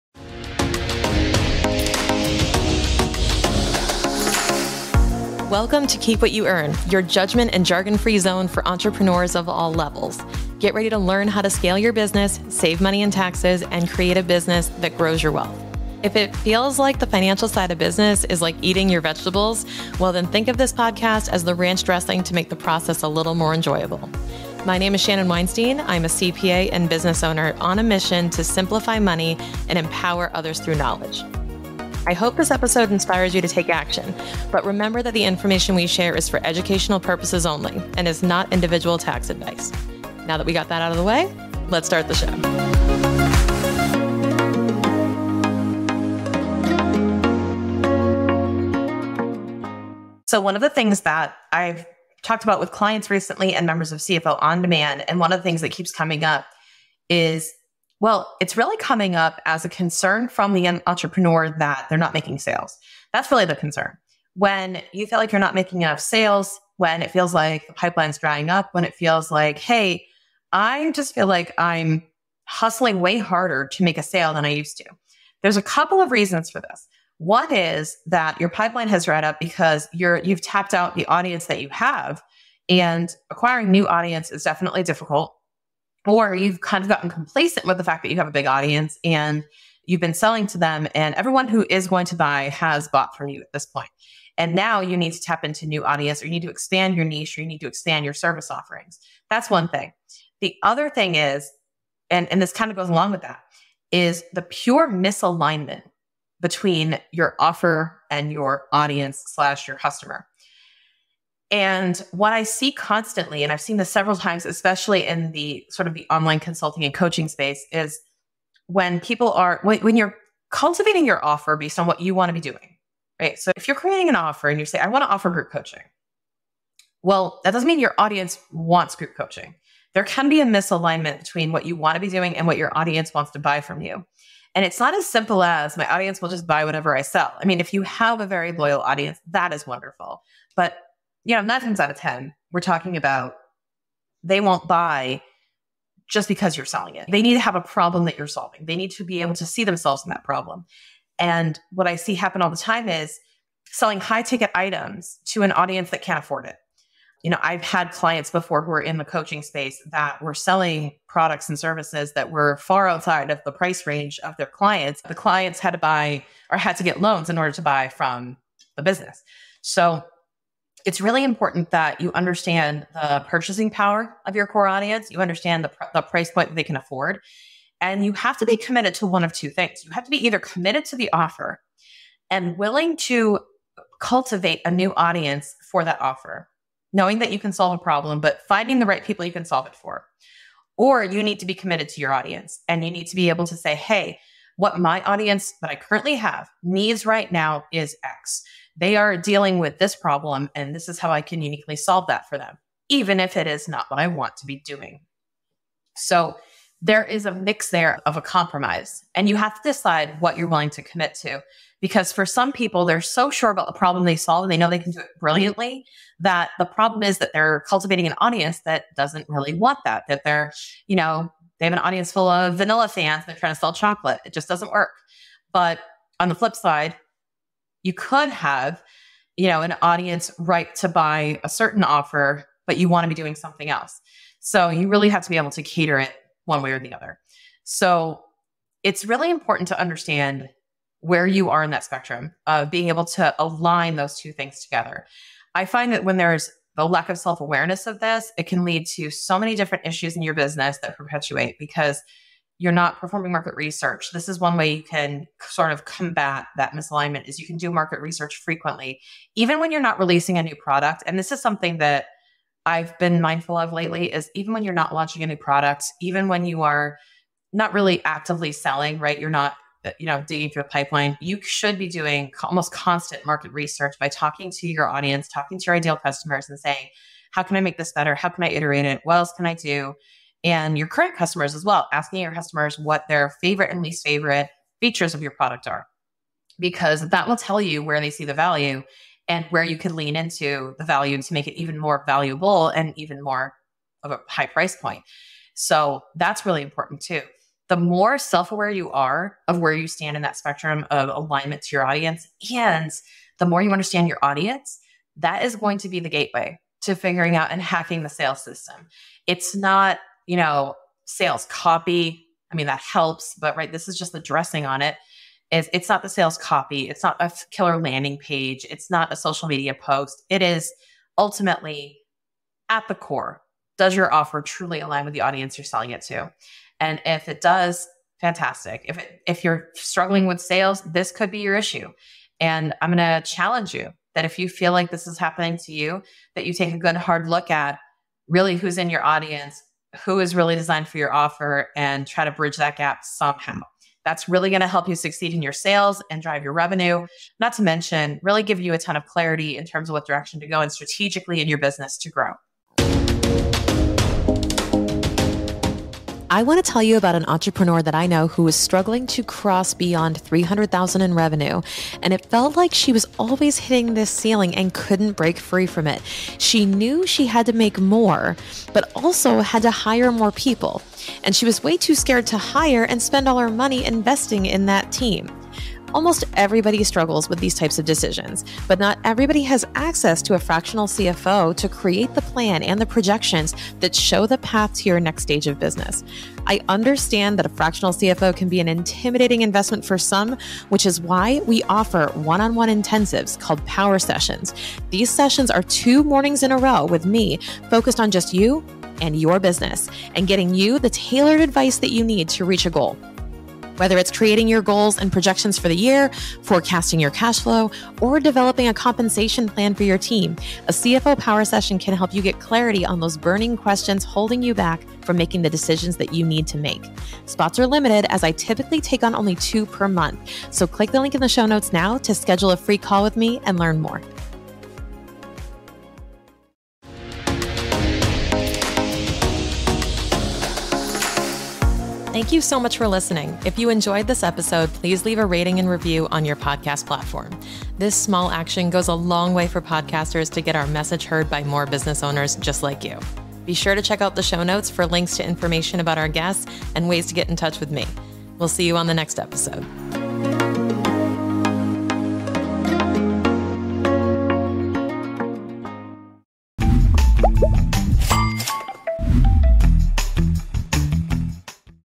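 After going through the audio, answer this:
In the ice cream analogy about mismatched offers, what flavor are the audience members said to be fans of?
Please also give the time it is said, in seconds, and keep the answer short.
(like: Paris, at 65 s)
vanilla, at 222 s.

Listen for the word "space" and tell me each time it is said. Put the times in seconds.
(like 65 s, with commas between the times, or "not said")
117 s, 159 s.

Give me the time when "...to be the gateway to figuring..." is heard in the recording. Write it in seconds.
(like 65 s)
305 s.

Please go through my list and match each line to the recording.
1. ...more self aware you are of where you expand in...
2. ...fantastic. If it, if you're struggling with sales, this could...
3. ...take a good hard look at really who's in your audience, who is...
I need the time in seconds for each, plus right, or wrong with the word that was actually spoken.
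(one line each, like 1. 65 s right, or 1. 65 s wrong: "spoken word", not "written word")
1. 297 s wrong: "stand", not "expand"
2. 328 s right
3. 336 s right.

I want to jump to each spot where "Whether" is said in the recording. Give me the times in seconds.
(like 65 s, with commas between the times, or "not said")
403 s.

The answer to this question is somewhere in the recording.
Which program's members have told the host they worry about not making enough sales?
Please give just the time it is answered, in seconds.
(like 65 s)
53 s.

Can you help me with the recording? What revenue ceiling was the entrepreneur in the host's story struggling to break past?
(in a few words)
300,000.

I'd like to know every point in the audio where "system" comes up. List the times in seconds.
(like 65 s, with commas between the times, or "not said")
308 s.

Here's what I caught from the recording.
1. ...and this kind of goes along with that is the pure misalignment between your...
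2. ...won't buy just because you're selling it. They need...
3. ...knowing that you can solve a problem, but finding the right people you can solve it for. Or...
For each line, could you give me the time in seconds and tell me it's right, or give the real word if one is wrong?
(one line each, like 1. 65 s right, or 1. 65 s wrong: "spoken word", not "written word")
1. 102 s right
2. 144 s right
3. 186 s right.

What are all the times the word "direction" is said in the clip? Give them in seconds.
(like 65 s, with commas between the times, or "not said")
350 s.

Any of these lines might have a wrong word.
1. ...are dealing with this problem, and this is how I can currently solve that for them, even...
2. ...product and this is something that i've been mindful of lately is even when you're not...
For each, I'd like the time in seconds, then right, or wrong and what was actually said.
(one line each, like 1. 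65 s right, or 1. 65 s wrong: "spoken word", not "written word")
1. 198 s wrong: "uniquely", not "currently"
2. 260 s right.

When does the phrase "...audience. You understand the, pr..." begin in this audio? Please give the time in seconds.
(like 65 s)
174 s.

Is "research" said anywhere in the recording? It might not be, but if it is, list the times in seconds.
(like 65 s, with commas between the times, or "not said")
253 s, 257 s, 273 s.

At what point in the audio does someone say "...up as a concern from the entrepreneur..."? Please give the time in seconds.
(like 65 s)
59 s.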